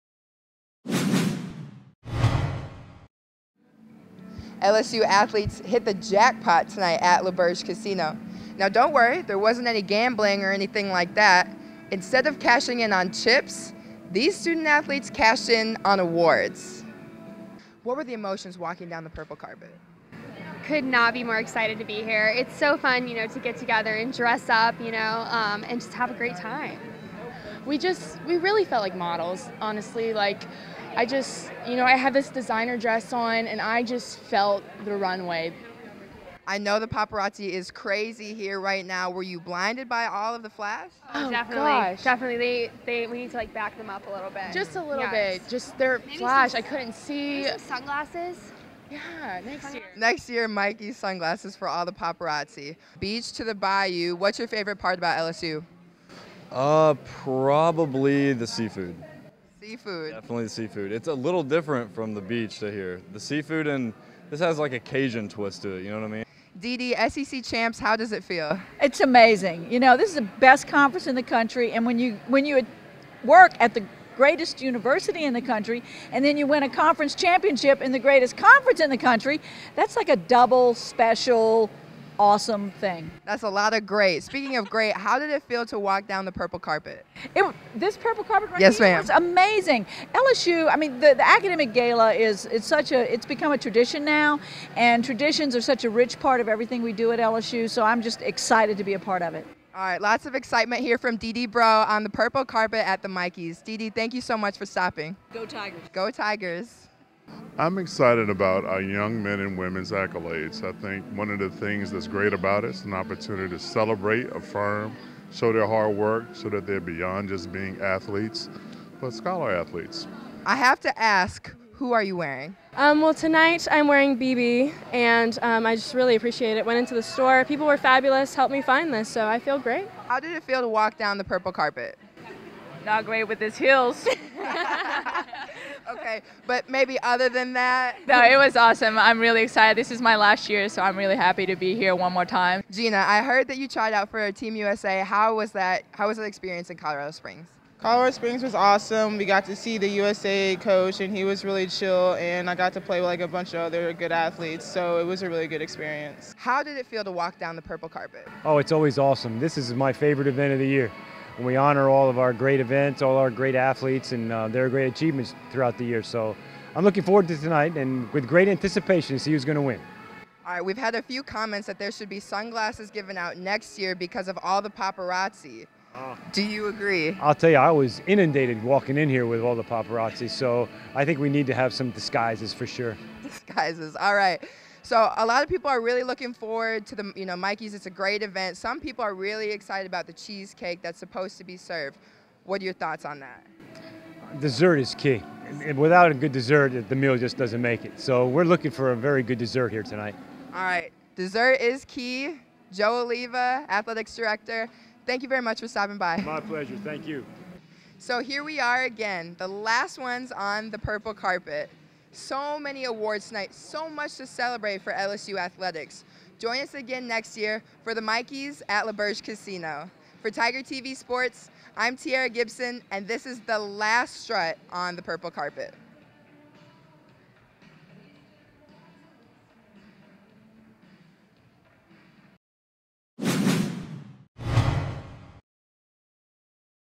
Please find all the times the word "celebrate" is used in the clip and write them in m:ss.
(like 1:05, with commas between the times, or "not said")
1:53, 3:34.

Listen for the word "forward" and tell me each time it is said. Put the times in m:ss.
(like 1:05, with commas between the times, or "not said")
2:47, 3:06.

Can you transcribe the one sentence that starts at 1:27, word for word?
It, this purple carpet right yes, here was amazing.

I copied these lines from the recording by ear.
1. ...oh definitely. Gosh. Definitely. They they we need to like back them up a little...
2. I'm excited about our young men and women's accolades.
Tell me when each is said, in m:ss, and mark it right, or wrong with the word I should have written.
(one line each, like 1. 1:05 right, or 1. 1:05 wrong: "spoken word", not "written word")
1. 0:41 right
2. 1:47 right.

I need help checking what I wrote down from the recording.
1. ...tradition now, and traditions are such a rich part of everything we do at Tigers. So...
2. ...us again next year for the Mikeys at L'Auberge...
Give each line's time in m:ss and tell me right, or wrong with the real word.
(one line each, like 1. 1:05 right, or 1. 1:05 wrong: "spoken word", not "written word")
1. 1:33 wrong: "LSU", not "Tigers"
2. 3:36 right.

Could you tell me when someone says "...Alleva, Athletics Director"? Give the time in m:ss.
3:23.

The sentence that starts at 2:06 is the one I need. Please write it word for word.
Went into the store, people were fabulous, helped me find this, so I feel great.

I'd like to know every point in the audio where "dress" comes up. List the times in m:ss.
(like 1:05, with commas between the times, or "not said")
0:24, 0:32.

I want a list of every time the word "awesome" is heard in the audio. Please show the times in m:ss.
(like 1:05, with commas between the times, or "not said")
1:22, 2:18, 2:28, 2:38.